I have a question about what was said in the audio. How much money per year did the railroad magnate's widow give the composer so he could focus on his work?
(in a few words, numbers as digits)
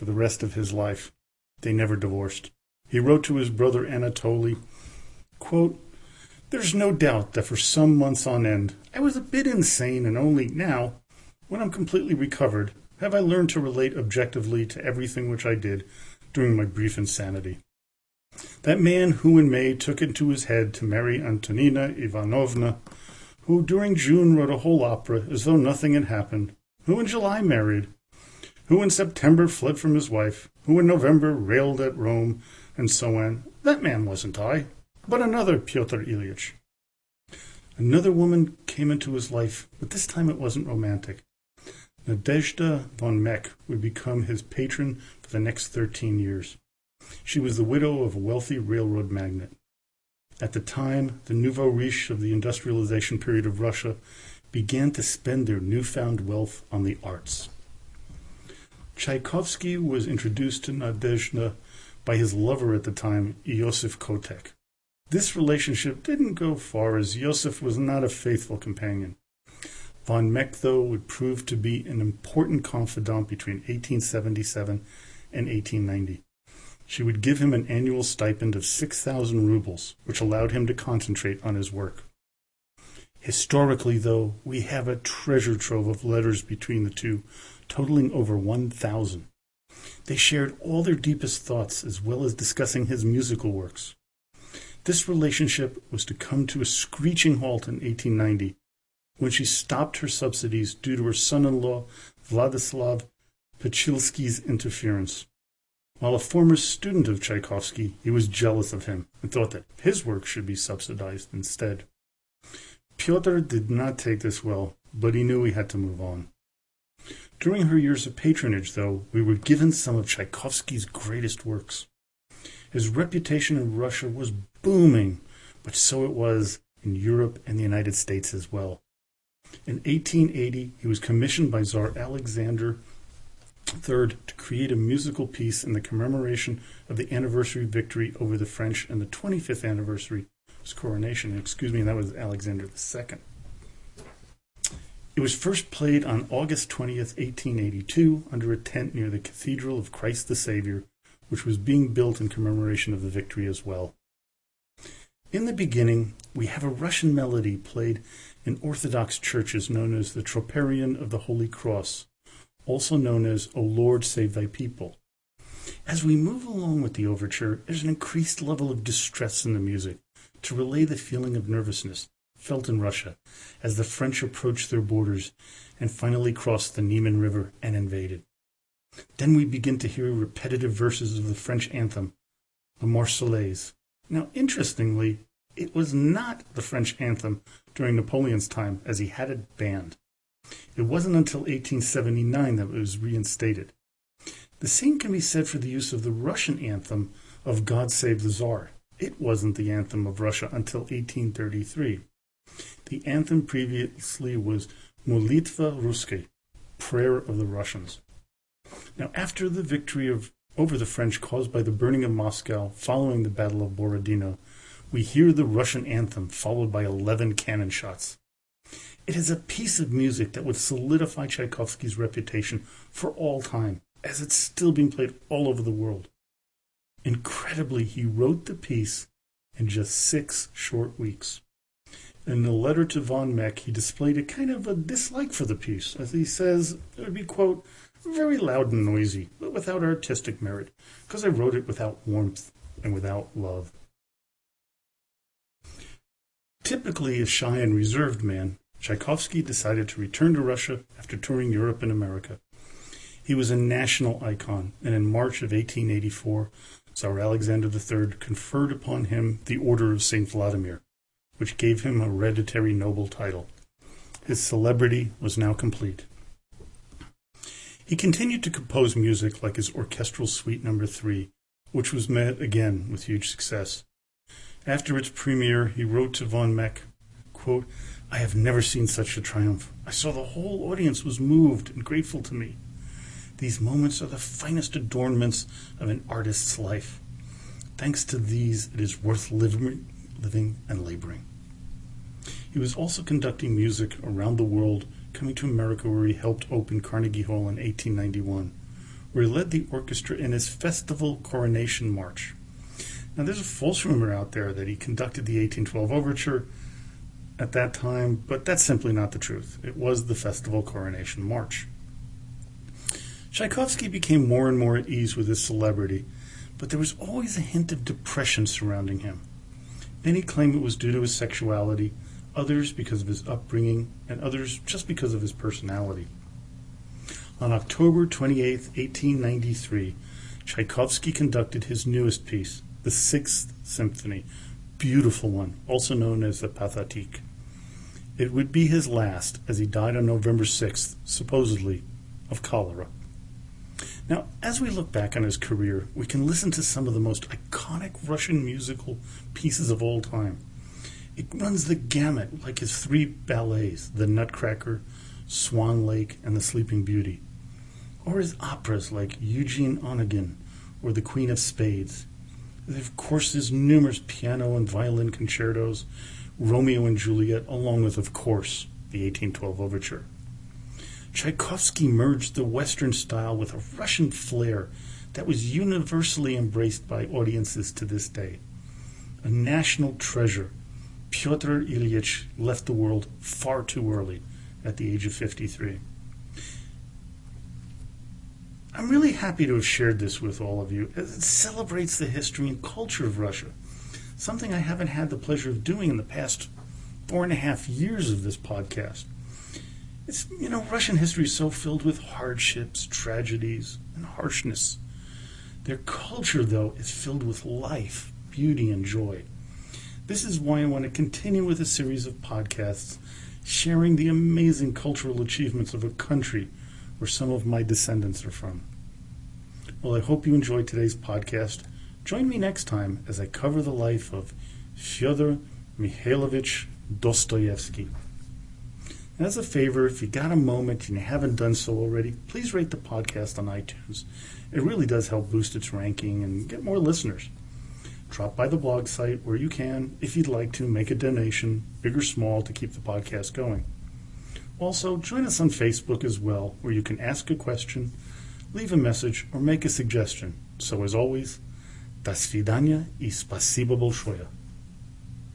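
6,000 roubles.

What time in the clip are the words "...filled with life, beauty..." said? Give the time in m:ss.
6:46.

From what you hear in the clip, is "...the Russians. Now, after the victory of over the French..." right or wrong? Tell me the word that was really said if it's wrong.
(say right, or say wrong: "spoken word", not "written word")
right.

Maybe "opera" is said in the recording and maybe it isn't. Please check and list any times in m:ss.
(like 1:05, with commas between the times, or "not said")
0:24, 5:58.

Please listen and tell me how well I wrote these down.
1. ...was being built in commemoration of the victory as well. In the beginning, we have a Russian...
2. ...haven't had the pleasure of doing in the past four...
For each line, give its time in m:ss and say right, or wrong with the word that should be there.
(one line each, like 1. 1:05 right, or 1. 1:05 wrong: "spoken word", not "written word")
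1. 2:31 right
2. 6:34 right.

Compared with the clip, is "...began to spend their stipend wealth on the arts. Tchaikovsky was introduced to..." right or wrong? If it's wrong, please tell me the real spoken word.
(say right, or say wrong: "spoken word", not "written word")
wrong: "newfound", not "stipend".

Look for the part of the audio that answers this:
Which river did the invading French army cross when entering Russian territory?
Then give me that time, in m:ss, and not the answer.
2:56.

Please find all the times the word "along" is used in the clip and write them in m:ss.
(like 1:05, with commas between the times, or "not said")
2:46, 6:07.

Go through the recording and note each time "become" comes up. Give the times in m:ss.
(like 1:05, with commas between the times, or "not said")
0:43.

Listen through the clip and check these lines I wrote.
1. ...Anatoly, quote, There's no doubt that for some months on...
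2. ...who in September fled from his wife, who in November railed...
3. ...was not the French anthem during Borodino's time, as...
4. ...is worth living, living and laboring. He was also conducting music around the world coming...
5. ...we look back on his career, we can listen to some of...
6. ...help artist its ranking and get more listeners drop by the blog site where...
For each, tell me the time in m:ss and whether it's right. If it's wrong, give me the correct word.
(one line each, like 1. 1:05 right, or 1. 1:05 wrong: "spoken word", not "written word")
1. 0:03 right
2. 0:28 right
3. 3:05 wrong: "Napoleon", not "Borodino"
4. 4:48 right
5. 5:44 right
6. 7:15 wrong: "boost", not "artist".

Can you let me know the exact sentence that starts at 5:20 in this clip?
Many claim it was due to his sexuality, others because of his upbringing, and others just because of his personality.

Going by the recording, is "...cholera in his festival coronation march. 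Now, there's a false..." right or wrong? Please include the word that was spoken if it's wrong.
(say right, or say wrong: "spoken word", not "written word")
wrong: "orchestra", not "cholera".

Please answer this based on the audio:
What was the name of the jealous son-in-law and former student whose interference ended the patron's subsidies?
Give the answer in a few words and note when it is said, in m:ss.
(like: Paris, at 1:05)
Vladislav Pachulski, at 1:42.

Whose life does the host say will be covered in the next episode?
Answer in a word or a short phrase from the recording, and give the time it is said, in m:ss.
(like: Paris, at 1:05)
Fyodor Mikhailovich Dostoevsky, at 7:04.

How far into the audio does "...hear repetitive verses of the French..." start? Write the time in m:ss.
2:59.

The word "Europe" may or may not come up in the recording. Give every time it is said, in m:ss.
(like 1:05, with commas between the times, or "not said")
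2:06, 4:11.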